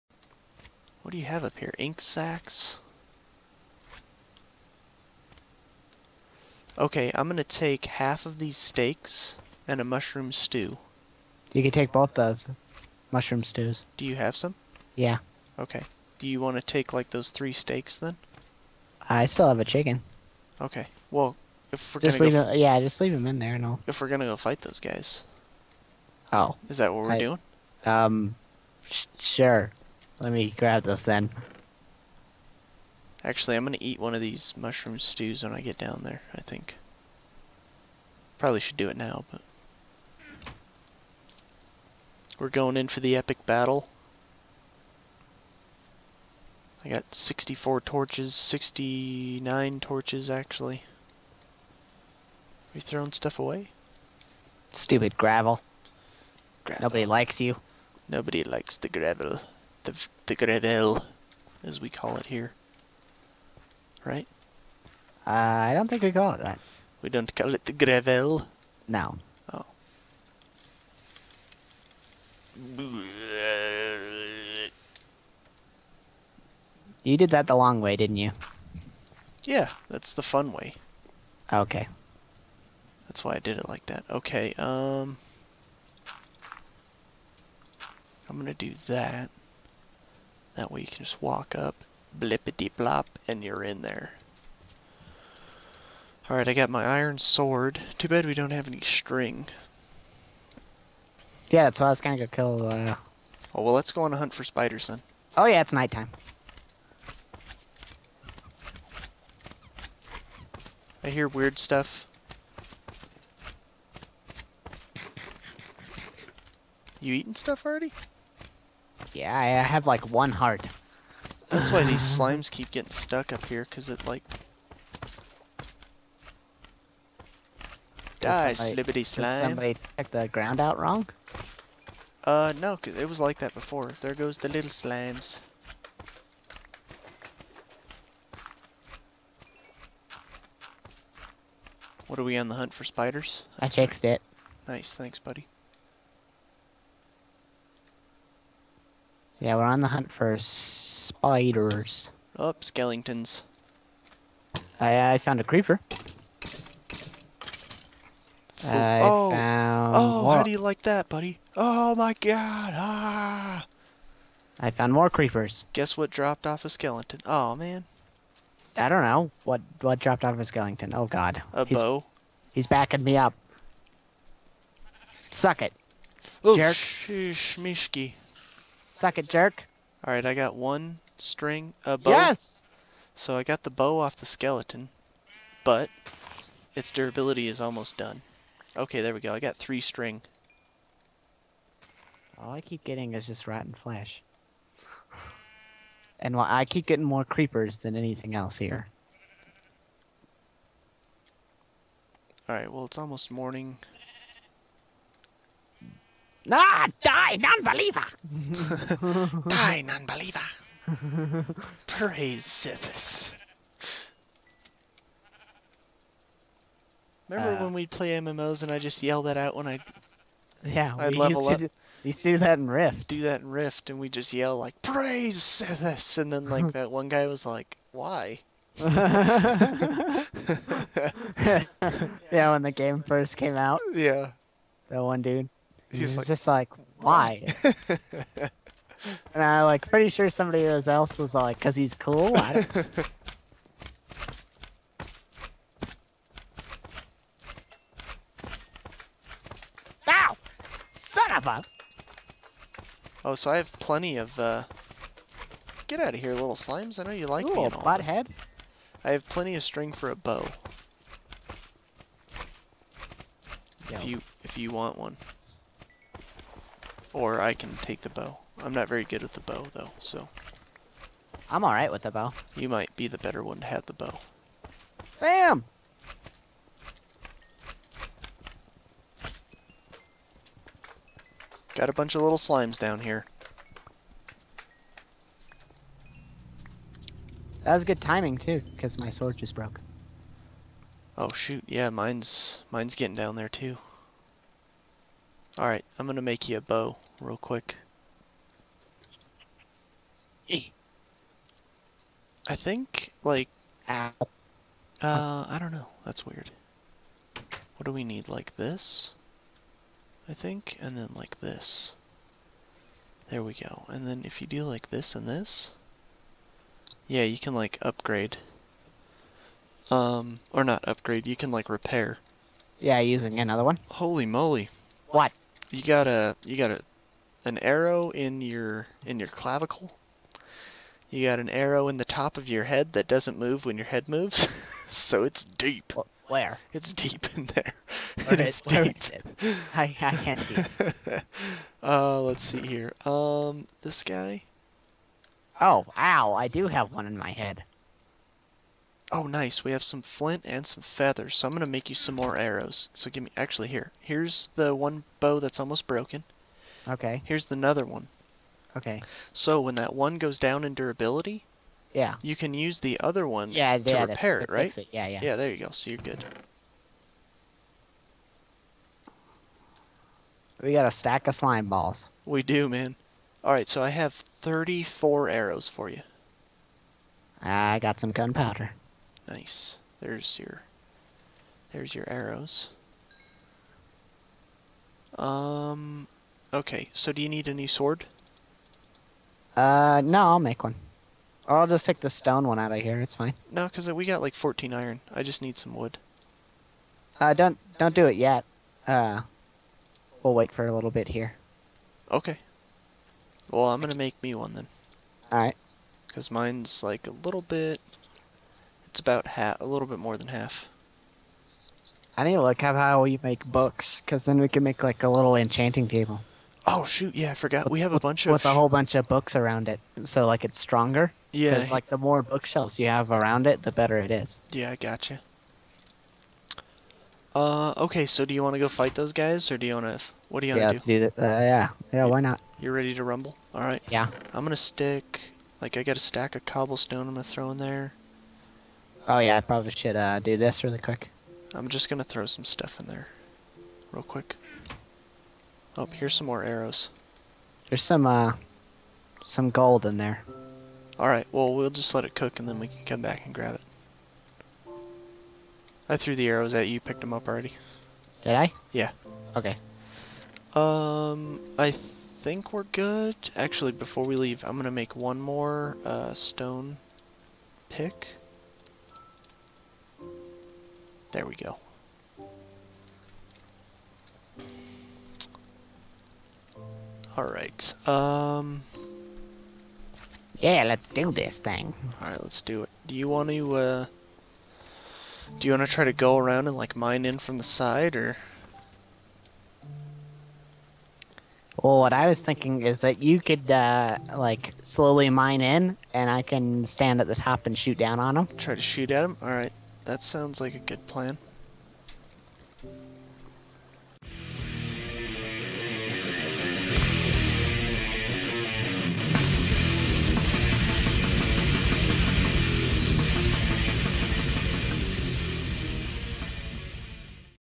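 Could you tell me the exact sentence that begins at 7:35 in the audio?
I threw the arrows at you.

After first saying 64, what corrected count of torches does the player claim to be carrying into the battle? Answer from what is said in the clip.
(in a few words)
69.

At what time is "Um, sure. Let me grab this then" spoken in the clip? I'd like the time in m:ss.
0:27.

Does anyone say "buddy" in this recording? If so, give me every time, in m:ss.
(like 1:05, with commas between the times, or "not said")
2:25, 2:41.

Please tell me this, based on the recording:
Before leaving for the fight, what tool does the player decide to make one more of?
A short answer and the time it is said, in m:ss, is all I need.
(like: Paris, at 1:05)
stone pick, at 7:46.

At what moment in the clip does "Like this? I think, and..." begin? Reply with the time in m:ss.
5:08.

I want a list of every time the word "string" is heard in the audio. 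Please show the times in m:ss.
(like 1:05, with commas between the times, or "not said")
1:38, 3:01, 3:09, 4:19.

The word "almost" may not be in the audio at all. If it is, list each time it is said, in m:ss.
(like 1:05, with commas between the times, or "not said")
3:07, 3:22, 5:55.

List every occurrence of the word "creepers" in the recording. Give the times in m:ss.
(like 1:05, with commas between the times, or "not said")
2:35, 2:45, 3:17.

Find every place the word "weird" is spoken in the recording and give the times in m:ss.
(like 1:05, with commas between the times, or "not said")
1:51, 5:06.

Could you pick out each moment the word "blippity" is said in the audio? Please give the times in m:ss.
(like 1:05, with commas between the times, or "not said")
1:32.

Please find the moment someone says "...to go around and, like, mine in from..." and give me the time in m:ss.
8:05.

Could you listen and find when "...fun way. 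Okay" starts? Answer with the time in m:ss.
1:20.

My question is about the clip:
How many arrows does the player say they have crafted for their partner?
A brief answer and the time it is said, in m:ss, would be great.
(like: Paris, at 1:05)
34, at 6:14.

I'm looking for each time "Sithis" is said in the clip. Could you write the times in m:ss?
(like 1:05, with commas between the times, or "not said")
3:32, 3:45.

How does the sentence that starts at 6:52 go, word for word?
I need to look up how we make books, because then we can make like a little enchanting table.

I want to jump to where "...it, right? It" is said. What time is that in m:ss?
6:04.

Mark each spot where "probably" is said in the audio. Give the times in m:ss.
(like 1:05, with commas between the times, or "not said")
0:38, 7:19.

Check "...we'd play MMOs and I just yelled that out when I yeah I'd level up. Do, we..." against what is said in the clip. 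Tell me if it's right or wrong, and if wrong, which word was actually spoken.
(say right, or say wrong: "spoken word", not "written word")
right.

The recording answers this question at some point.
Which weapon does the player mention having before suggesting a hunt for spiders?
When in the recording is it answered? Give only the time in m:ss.
1:36.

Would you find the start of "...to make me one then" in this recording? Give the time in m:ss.
6:43.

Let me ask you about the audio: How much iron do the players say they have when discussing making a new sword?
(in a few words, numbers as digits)
14.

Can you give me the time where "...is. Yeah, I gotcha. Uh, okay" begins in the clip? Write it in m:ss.
7:04.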